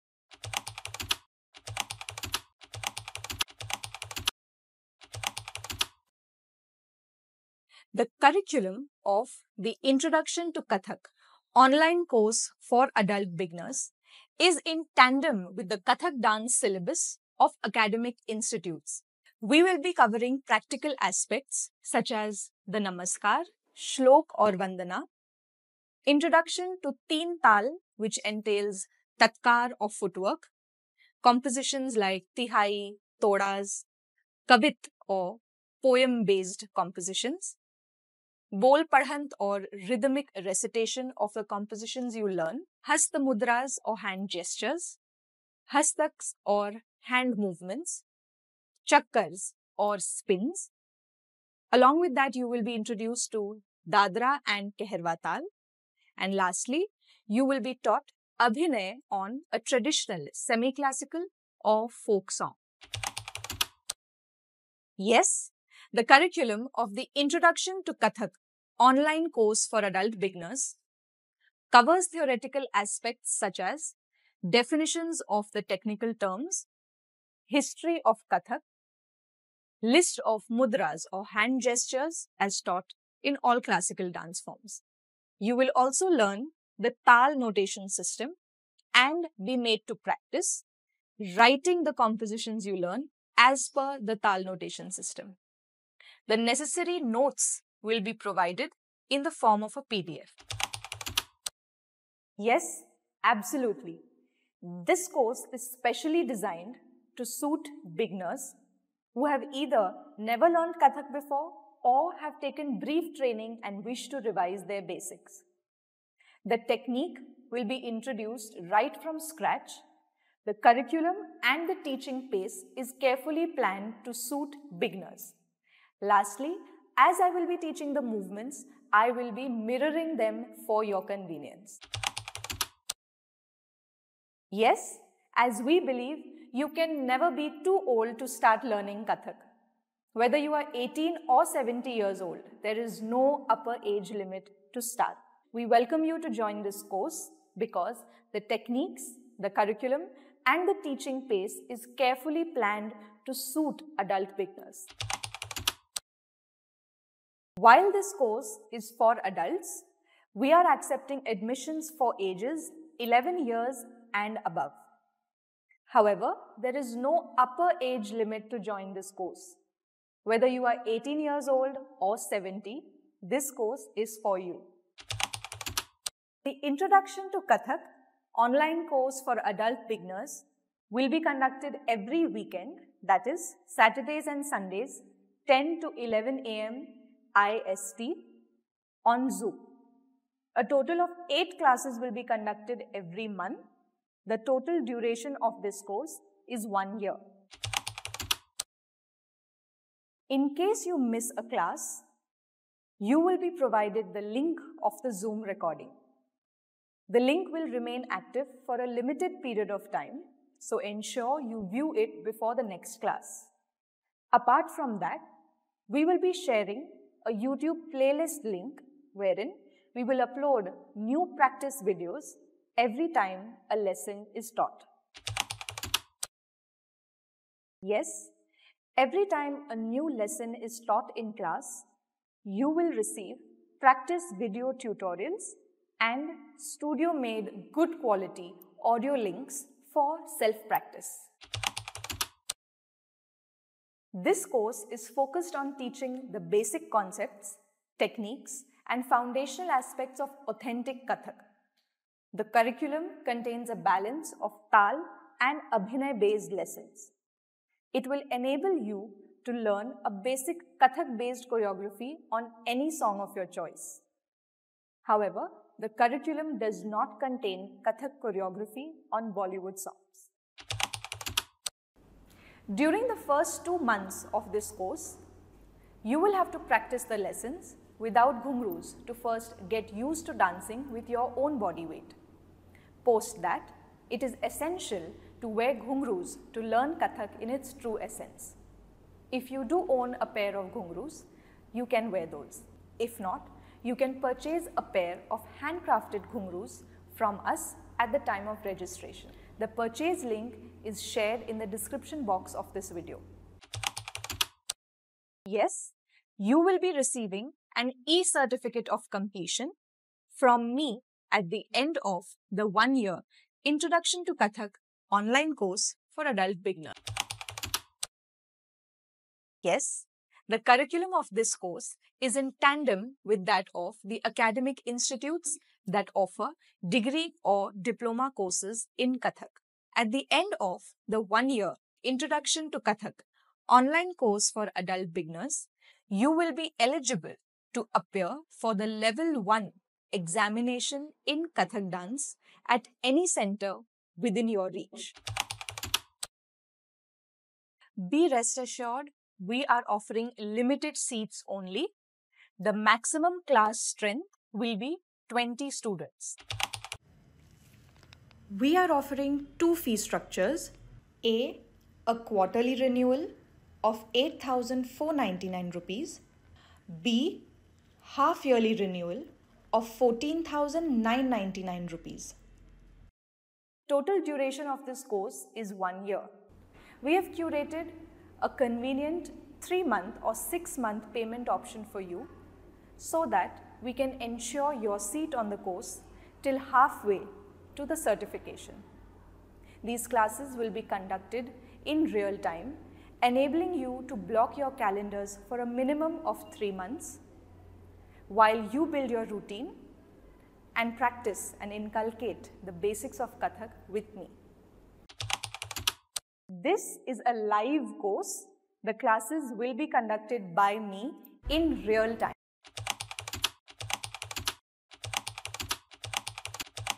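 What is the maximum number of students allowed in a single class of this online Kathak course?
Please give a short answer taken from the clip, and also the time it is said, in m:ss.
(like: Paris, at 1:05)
20, at 5:55.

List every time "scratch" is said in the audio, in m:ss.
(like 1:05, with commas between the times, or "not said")
1:59.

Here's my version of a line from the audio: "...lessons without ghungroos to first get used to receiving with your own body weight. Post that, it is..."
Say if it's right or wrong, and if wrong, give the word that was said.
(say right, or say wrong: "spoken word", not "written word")
wrong: "dancing", not "receiving".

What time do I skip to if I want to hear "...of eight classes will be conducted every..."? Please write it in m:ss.
3:11.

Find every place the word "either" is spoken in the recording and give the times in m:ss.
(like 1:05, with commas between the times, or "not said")
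1:49.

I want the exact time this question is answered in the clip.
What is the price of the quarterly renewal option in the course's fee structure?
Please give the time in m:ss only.
6:04.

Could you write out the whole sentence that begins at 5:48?
Be rest assured we are offering limited seats only.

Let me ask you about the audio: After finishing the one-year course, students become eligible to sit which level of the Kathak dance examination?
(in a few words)
Level 1.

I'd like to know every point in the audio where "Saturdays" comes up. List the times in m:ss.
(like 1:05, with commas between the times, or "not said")
3:03.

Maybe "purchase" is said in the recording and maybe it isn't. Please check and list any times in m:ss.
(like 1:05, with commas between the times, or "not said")
4:54, 4:59.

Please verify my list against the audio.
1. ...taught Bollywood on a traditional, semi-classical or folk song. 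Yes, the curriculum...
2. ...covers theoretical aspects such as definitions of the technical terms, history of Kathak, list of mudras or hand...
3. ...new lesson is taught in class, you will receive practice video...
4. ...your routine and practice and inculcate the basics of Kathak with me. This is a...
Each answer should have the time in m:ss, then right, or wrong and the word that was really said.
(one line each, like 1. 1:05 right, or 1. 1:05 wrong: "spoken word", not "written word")
1. 0:57 wrong: "Abhinay", not "Bollywood"
2. 1:11 right
3. 3:49 right
4. 6:39 right.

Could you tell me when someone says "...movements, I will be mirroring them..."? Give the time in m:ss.
2:08.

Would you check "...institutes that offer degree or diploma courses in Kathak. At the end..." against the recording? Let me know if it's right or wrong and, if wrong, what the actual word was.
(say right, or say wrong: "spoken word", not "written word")
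right.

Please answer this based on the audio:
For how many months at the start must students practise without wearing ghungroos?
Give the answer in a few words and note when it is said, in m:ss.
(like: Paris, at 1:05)
2, at 4:33.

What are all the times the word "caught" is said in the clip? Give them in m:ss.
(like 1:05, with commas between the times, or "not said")
not said.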